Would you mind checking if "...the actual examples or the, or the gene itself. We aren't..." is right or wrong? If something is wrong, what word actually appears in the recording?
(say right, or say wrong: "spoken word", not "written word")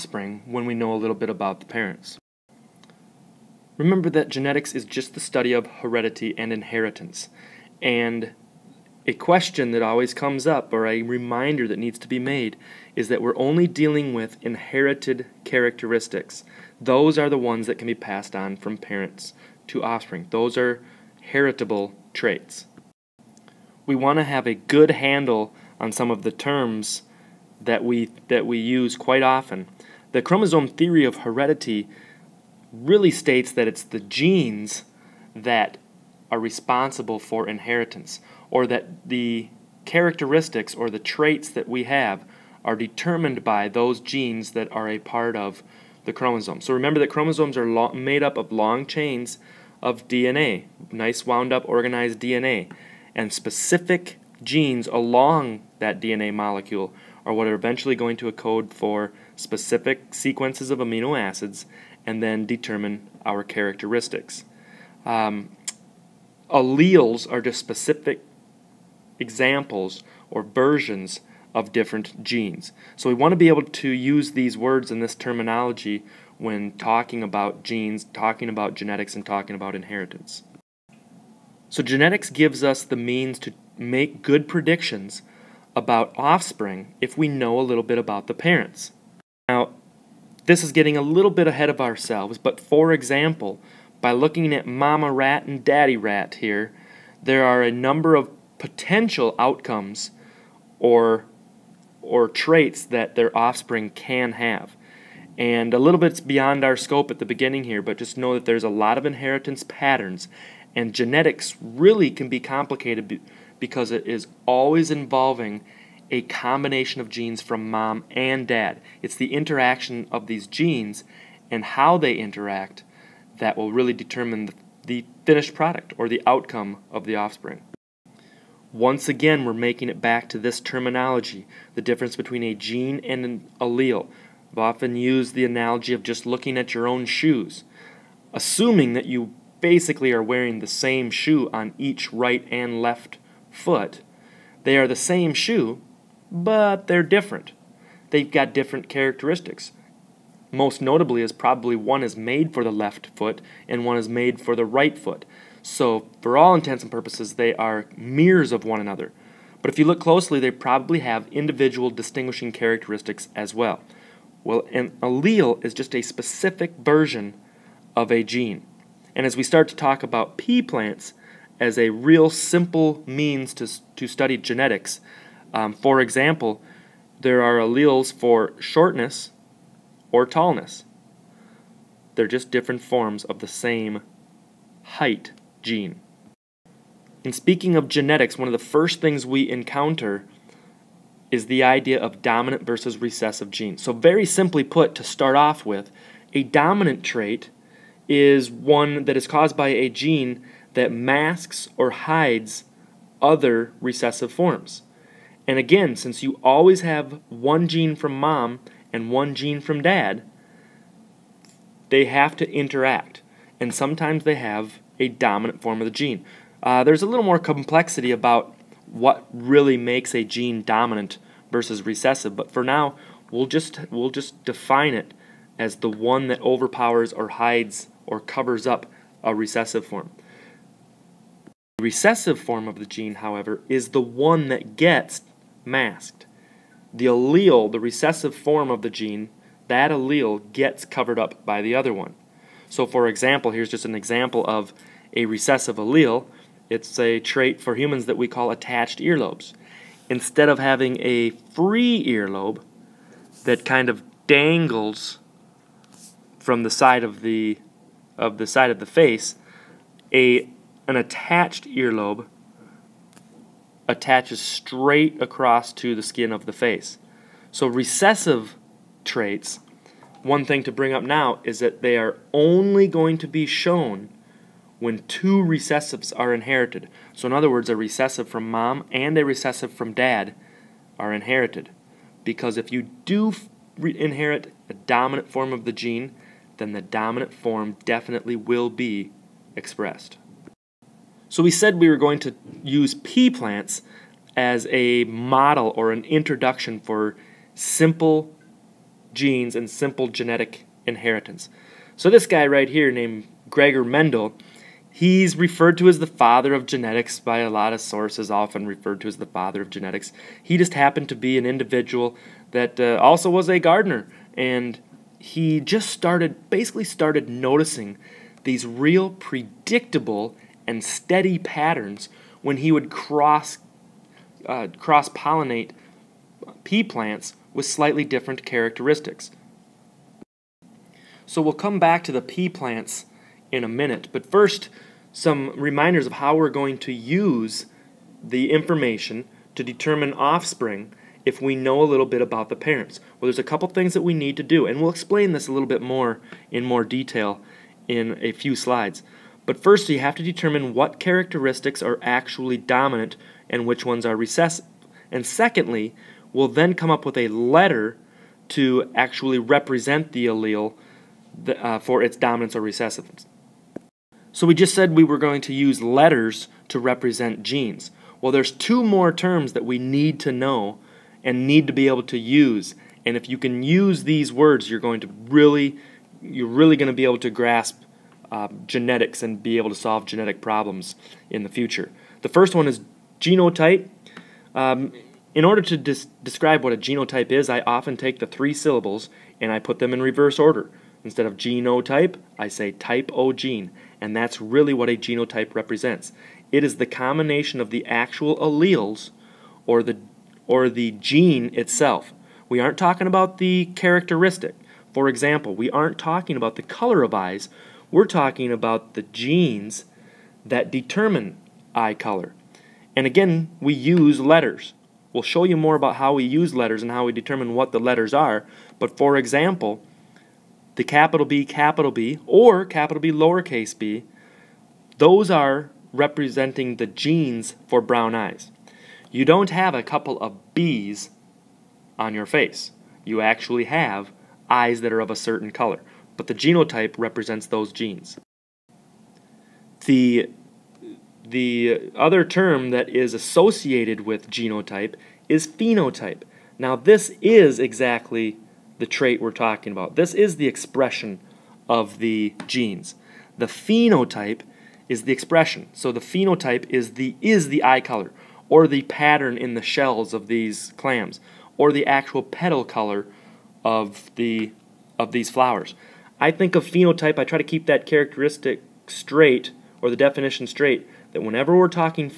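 wrong: "alleles", not "examples".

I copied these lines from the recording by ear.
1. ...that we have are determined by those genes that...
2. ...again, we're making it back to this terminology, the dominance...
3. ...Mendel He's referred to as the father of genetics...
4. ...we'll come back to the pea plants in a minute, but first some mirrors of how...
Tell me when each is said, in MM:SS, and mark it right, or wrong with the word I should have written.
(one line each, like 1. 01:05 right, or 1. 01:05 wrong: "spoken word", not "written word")
1. 00:41 right
2. 02:09 wrong: "difference", not "dominance"
3. 05:03 right
4. 05:31 wrong: "reminders", not "mirrors".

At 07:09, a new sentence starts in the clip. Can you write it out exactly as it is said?
You don't have a couple of B's on your face.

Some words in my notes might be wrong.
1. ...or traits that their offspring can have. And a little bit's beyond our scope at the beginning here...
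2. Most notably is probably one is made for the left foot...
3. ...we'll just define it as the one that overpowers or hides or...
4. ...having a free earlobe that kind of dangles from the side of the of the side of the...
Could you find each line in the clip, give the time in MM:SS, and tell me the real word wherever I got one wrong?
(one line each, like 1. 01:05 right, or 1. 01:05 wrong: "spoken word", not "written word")
1. 01:42 right
2. 02:30 right
3. 03:43 right
4. 04:10 right.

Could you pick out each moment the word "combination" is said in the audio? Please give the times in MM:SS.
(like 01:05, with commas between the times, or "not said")
01:56, 06:36.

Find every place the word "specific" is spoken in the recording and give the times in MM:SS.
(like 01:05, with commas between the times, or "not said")
00:53, 00:59, 01:07, 02:46.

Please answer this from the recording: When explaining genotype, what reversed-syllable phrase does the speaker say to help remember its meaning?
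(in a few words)
Type O gene.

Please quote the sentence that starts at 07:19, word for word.
The, the other term that is associated with genotype is phenotype.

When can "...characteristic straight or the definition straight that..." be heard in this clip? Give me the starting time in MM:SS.
07:47.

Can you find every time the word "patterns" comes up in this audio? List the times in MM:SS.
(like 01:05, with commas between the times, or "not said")
01:49, 05:21, 07:38.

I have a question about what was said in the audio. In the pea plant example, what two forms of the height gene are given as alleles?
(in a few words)
Shortness or tallness.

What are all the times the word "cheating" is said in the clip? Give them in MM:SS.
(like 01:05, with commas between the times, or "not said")
not said.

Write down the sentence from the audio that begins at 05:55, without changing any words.
And secondly, we'll then come up with a letter to actually represent the allele uh, for its dominance or recessiveness.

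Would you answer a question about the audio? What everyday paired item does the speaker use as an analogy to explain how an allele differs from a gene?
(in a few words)
Shoes.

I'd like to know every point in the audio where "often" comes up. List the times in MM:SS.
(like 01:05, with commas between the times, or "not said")
00:29, 02:14, 05:08, 06:27.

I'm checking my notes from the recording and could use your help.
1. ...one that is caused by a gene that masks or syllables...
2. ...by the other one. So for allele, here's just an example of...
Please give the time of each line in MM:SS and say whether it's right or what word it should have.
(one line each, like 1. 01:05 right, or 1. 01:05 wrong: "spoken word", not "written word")
1. 03:18 wrong: "hides", not "syllables"
2. 04:01 wrong: "example", not "allele".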